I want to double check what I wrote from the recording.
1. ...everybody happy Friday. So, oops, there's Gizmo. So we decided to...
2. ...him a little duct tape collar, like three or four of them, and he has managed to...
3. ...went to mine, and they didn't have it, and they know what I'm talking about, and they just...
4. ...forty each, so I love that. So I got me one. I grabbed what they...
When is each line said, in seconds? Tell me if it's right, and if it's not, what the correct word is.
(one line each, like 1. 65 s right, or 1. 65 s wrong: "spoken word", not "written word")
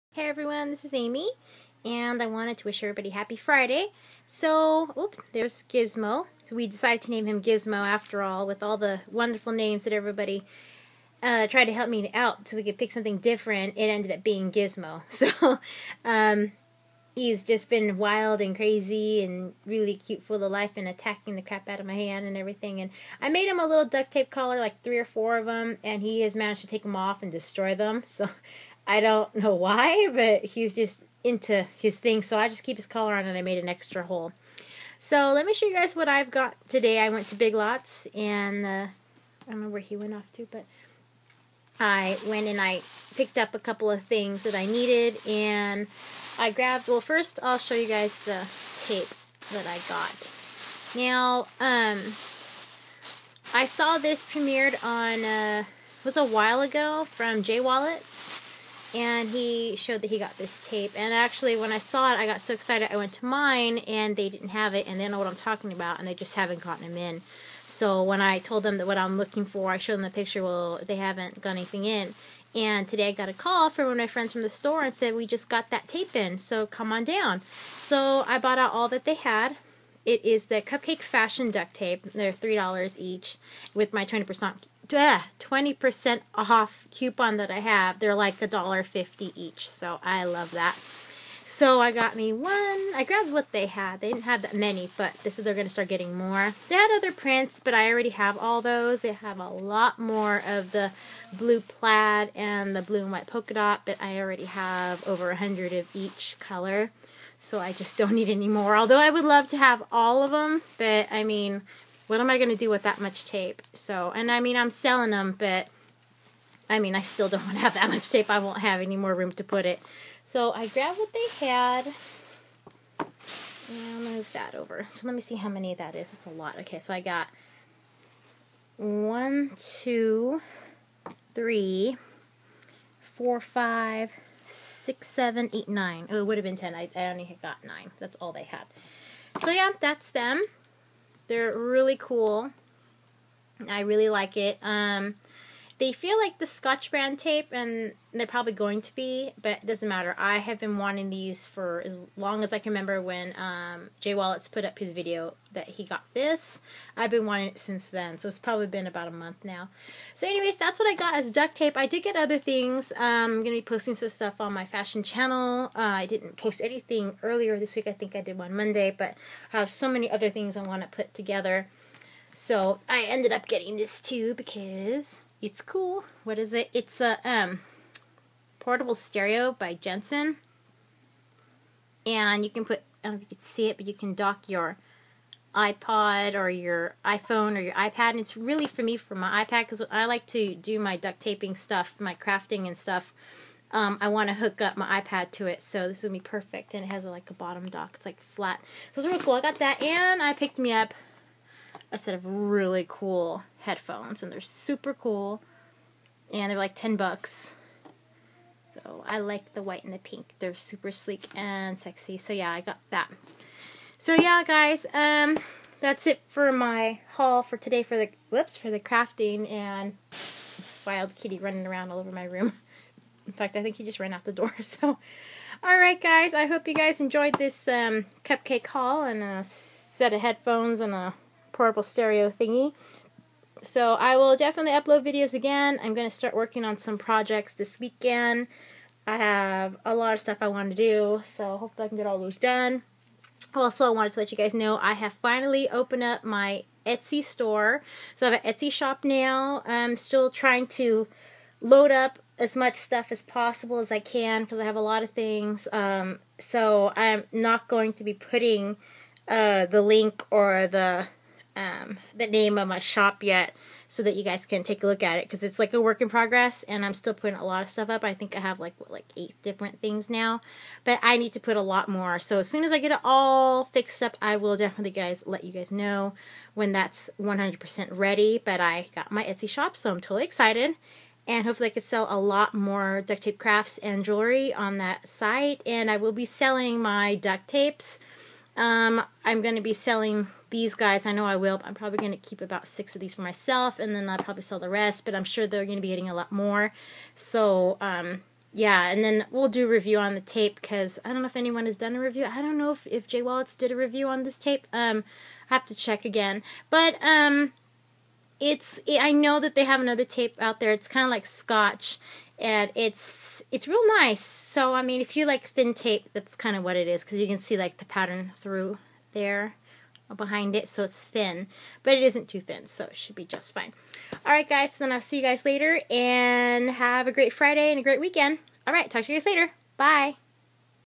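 1. 2 s right
2. 23 s right
3. 62 s right
4. 88 s wrong: "fifty", not "forty".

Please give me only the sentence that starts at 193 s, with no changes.
Um, I want to hook up my iPad to it, so this is going to be perfect.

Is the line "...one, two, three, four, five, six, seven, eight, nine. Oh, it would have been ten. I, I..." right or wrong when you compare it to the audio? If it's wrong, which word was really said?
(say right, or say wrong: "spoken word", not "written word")
right.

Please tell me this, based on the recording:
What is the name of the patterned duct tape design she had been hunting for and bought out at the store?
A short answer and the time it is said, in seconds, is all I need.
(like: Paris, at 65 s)
Cupcake Fashion, at 80 s.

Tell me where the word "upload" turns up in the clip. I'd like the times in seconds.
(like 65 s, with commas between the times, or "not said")
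234 s.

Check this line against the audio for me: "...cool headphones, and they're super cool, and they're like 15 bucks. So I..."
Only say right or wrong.
wrong.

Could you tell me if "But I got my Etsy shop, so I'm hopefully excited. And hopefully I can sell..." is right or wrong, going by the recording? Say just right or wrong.
wrong.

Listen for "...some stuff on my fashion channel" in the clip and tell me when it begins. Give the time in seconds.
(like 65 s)
163 s.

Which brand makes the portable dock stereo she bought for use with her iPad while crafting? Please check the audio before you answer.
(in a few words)
Jensen.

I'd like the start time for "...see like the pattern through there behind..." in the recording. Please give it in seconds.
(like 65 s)
317 s.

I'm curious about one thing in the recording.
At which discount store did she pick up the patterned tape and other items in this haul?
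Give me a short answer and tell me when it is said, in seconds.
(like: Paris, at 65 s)
Big Lots, at 37 s.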